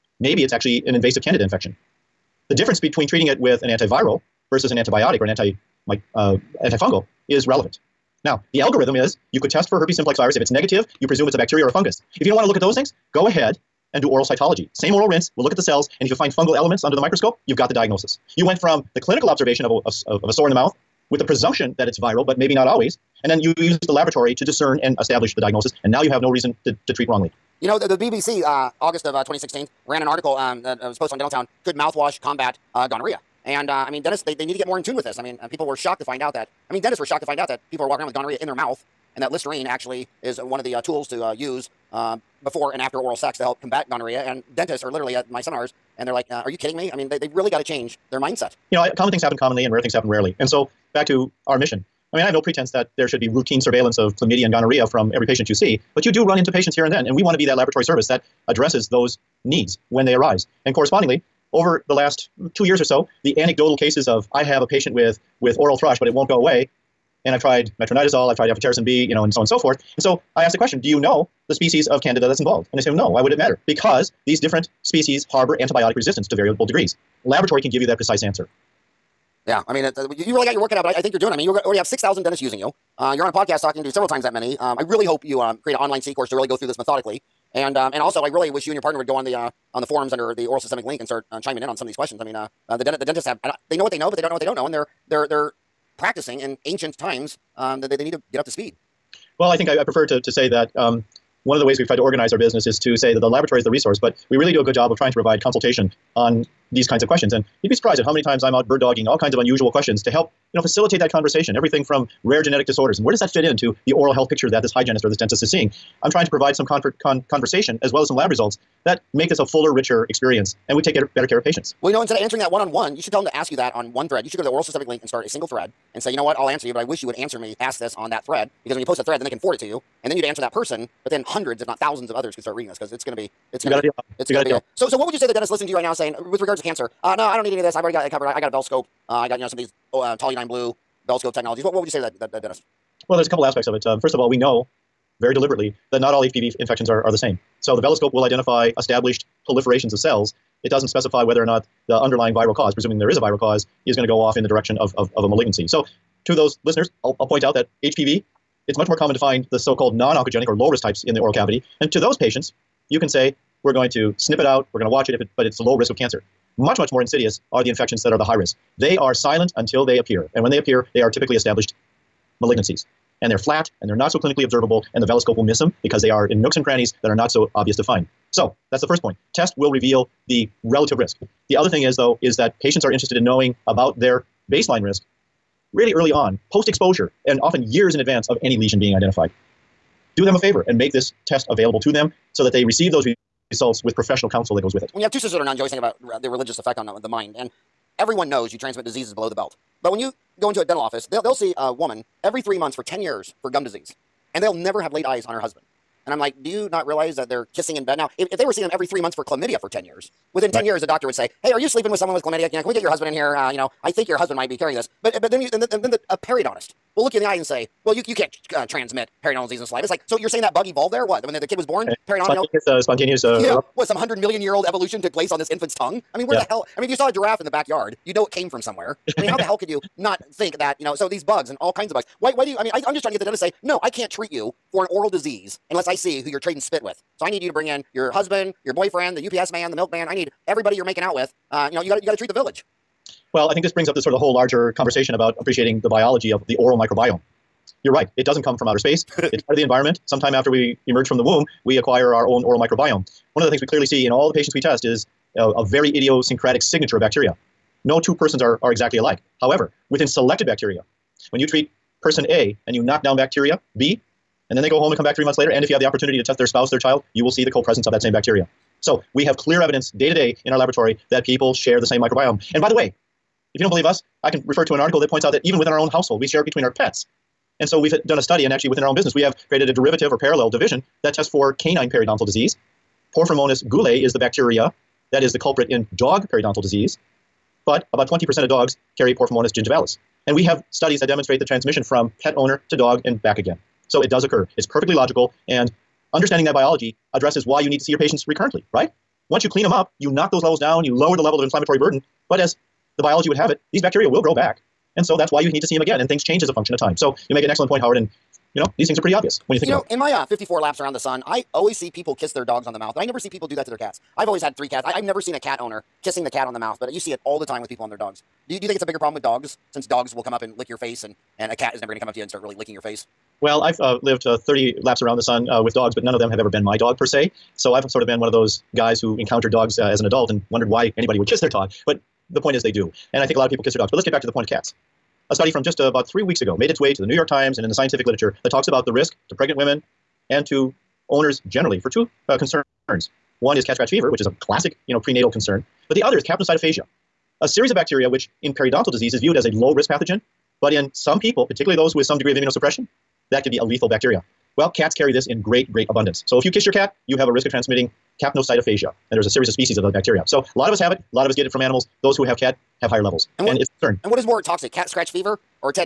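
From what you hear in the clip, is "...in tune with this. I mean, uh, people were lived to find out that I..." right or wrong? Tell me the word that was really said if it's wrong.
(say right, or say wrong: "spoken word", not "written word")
wrong: "shocked", not "lived".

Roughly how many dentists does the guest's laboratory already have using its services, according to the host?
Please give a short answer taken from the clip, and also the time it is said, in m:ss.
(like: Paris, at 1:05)
6,000, at 1:21.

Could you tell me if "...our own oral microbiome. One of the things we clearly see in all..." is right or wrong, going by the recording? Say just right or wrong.
right.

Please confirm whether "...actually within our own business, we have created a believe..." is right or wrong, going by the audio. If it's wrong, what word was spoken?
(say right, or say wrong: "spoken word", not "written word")
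wrong: "derivative", not "believe".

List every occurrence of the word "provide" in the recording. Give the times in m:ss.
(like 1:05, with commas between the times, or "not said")
1:45, 1:56.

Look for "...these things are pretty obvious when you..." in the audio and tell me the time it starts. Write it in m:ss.
5:08.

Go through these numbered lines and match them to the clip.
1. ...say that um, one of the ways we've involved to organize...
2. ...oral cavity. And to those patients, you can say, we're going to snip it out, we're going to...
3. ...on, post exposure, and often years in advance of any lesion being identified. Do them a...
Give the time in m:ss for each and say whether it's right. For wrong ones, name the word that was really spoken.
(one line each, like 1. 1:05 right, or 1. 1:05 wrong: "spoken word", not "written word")
1. 1:40 wrong: "tried", not "involved"
2. 2:41 right
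3. 3:06 right.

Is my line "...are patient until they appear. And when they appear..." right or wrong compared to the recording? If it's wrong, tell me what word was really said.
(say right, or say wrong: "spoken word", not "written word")
wrong: "silent", not "patient".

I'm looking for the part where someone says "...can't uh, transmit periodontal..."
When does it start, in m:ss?
3:38.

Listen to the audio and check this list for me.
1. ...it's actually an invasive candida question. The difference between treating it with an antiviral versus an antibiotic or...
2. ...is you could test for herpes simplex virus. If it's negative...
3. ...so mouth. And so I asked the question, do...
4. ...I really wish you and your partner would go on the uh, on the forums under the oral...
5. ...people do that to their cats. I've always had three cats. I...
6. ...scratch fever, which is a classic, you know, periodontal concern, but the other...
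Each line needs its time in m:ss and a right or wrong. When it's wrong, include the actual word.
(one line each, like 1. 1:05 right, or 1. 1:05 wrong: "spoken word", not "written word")
1. 0:00 wrong: "infection", not "question"
2. 0:08 right
3. 1:09 wrong: "forth", not "mouth"
4. 1:28 right
5. 5:13 right
6. 5:43 wrong: "prenatal", not "periodontal".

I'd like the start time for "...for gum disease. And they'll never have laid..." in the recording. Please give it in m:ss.
3:23.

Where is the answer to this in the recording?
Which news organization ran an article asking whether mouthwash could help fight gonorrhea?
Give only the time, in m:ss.
0:27.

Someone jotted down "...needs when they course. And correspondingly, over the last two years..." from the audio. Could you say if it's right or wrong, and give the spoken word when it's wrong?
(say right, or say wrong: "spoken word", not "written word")
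wrong: "arise", not "course".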